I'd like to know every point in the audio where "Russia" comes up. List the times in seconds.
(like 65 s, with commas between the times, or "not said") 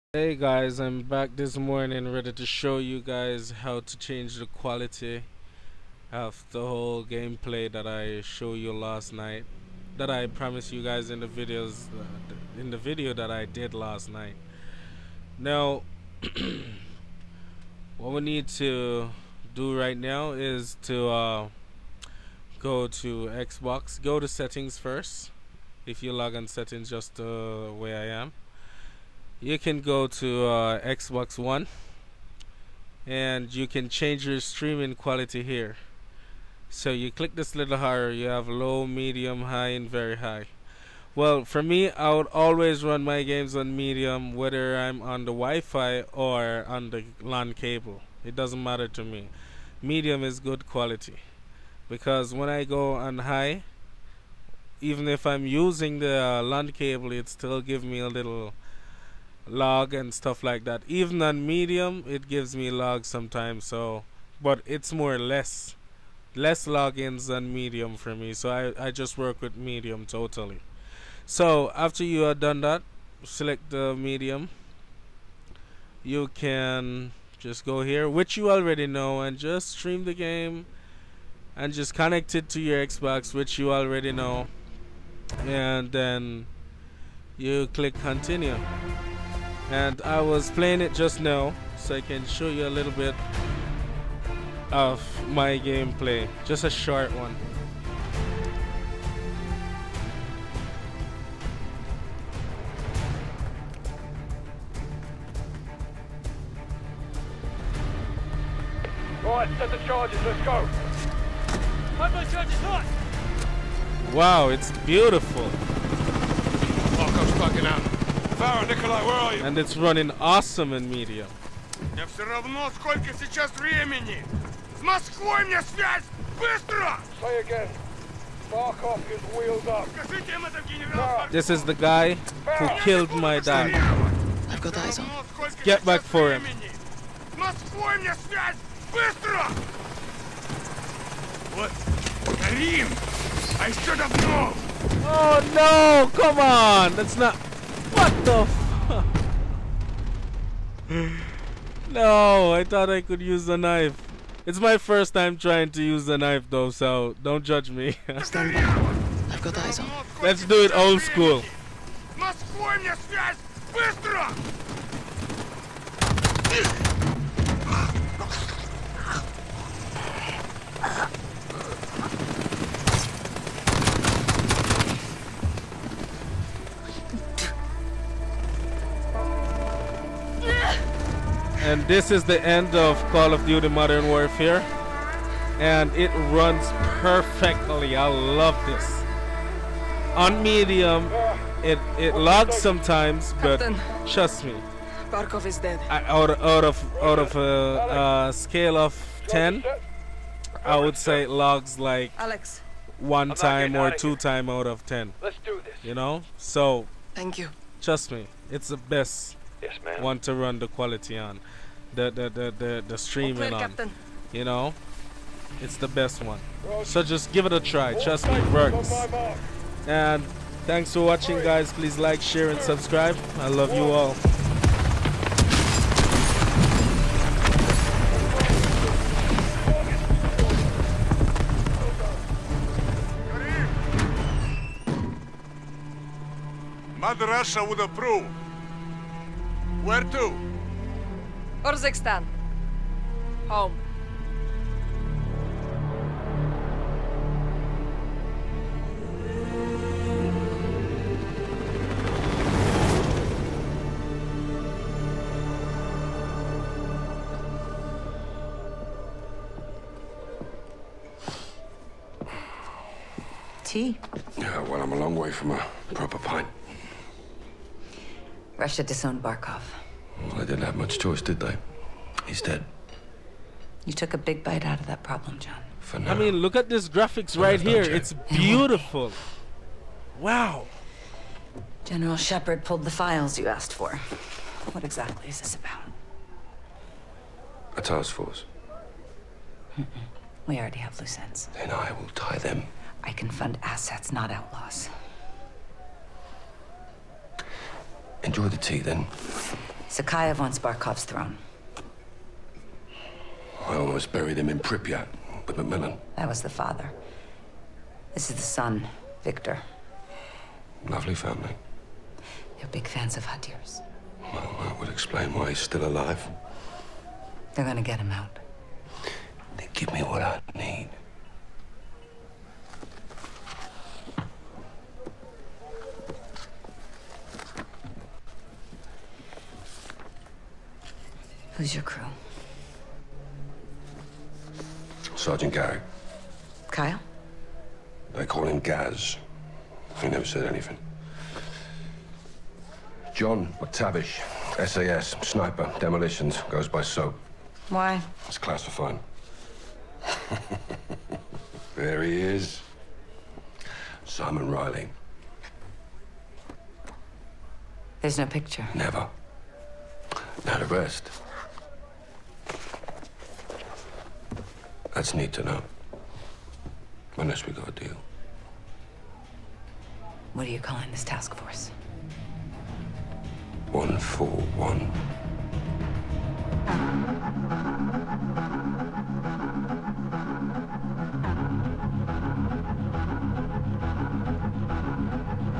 237 s, 268 s.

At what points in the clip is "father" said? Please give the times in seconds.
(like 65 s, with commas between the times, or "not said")
306 s.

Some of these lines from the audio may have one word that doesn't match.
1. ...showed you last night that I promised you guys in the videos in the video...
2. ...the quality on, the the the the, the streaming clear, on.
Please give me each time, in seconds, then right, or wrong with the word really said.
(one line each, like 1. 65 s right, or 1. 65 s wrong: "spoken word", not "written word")
1. 8 s right
2. 210 s right.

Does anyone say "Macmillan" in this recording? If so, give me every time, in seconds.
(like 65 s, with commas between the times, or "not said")
305 s.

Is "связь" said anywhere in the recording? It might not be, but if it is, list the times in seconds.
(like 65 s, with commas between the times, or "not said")
125 s, 138 s, 163 s.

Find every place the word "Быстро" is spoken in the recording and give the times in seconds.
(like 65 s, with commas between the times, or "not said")
126 s, 138 s, 163 s.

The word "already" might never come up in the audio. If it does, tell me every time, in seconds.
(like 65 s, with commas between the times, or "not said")
78 s, 83 s, 290 s.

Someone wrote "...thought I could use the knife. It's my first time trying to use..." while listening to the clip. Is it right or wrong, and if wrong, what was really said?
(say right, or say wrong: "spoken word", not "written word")
right.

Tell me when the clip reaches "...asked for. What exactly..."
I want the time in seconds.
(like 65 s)
283 s.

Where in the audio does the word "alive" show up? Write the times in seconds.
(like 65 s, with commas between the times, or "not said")
315 s.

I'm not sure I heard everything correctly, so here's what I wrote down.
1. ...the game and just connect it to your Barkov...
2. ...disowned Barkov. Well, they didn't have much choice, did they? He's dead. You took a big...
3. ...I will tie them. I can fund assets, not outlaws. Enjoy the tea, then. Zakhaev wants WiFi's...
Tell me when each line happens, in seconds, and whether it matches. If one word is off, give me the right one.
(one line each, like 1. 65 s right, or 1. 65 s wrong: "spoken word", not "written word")
1. 80 s wrong: "Xbox", not "Barkov"
2. 268 s right
3. 291 s wrong: "Barkov", not "WiFi".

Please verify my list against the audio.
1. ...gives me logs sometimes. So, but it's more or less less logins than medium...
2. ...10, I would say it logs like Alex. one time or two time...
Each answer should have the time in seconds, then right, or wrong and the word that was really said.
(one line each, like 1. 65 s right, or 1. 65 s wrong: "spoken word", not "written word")
1. 62 s right
2. 199 s right.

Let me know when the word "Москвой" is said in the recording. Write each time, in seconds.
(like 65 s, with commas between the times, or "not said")
124 s, 137 s.